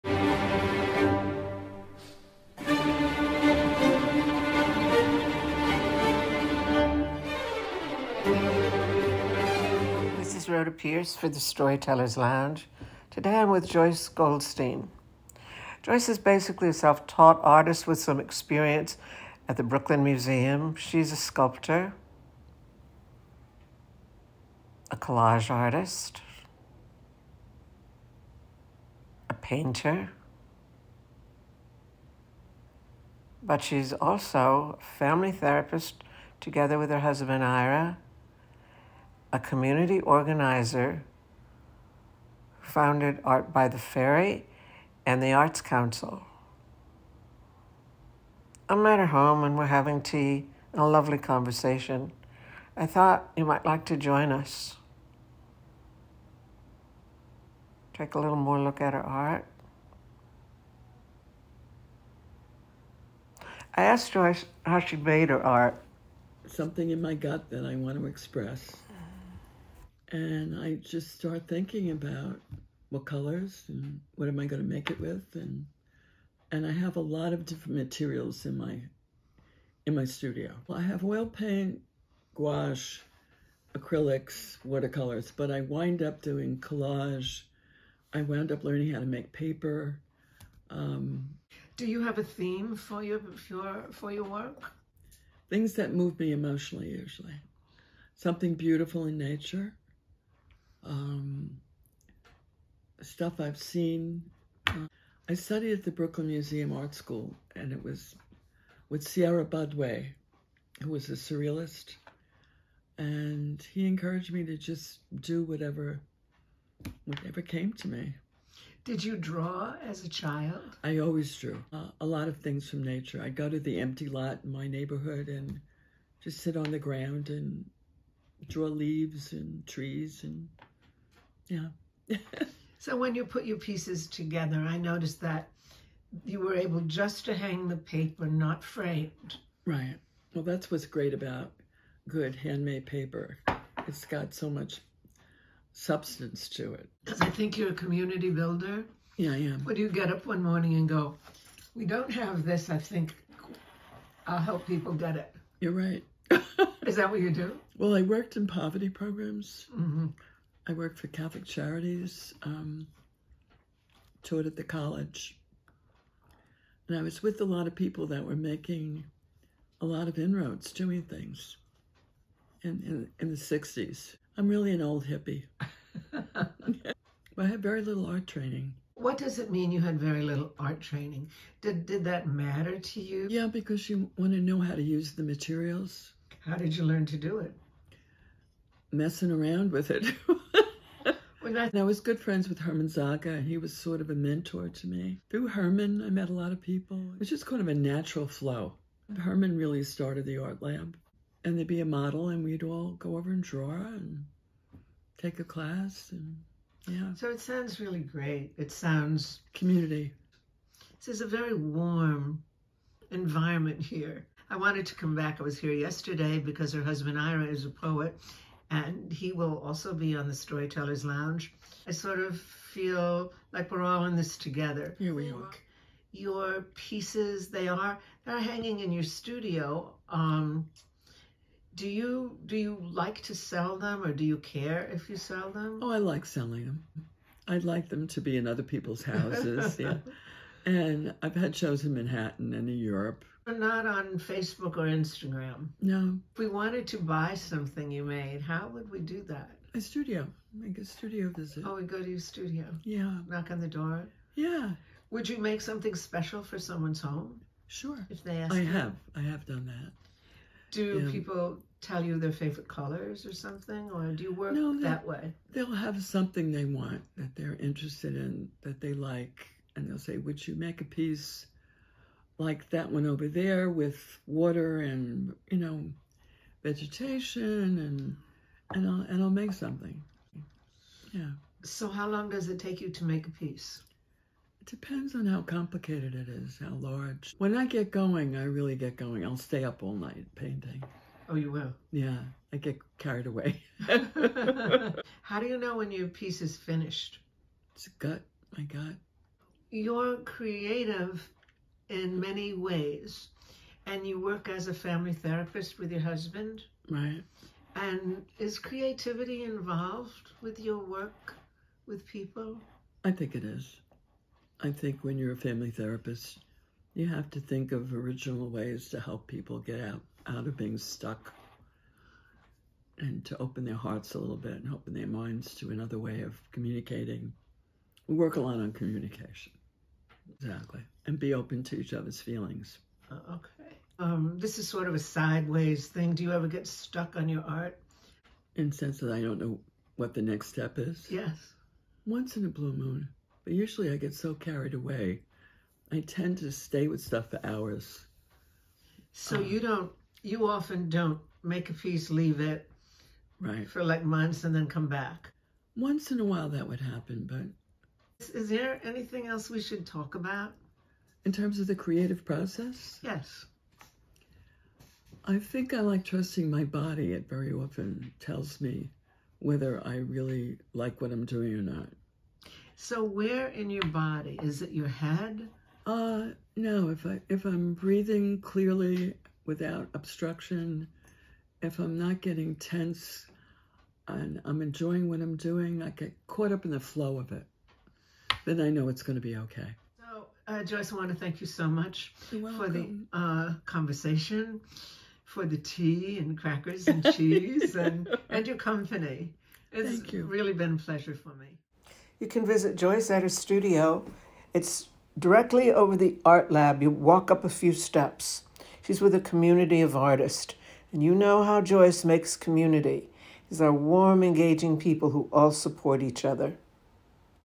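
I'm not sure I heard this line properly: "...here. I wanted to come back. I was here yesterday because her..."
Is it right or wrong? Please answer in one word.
right.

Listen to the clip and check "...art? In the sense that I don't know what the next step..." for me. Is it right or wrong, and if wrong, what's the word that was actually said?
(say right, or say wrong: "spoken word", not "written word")
right.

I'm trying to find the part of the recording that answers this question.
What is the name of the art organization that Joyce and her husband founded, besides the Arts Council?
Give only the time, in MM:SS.
00:43.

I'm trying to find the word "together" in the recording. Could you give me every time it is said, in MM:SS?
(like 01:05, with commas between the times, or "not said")
00:36, 02:14, 03:44.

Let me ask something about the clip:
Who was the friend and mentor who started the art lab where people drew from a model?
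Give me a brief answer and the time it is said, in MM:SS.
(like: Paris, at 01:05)
Herman Zaga, at 03:12.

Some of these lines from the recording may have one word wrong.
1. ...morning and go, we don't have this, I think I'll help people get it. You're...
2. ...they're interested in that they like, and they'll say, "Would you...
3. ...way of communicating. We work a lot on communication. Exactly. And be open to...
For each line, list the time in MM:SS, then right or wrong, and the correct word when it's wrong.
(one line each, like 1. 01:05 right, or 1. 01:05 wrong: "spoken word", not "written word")
1. 02:30 right
2. 04:27 right
3. 05:25 right.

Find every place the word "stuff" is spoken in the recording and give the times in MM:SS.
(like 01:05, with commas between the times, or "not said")
01:43, 05:47.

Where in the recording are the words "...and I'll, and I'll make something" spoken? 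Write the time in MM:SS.
04:38.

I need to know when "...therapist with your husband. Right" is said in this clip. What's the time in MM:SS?
05:05.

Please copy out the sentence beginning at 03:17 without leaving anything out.
It was just kind of a natural flow.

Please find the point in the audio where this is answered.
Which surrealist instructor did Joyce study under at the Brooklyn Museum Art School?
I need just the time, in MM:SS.
01:49.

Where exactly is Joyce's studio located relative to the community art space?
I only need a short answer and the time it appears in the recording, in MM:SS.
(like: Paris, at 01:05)
directly over the art lab, at 06:45.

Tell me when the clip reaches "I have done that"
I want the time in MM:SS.
04:19.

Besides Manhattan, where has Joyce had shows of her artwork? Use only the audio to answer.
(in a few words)
Europe.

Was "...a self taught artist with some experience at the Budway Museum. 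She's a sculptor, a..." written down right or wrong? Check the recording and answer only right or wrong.
wrong.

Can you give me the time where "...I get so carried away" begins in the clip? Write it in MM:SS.
05:43.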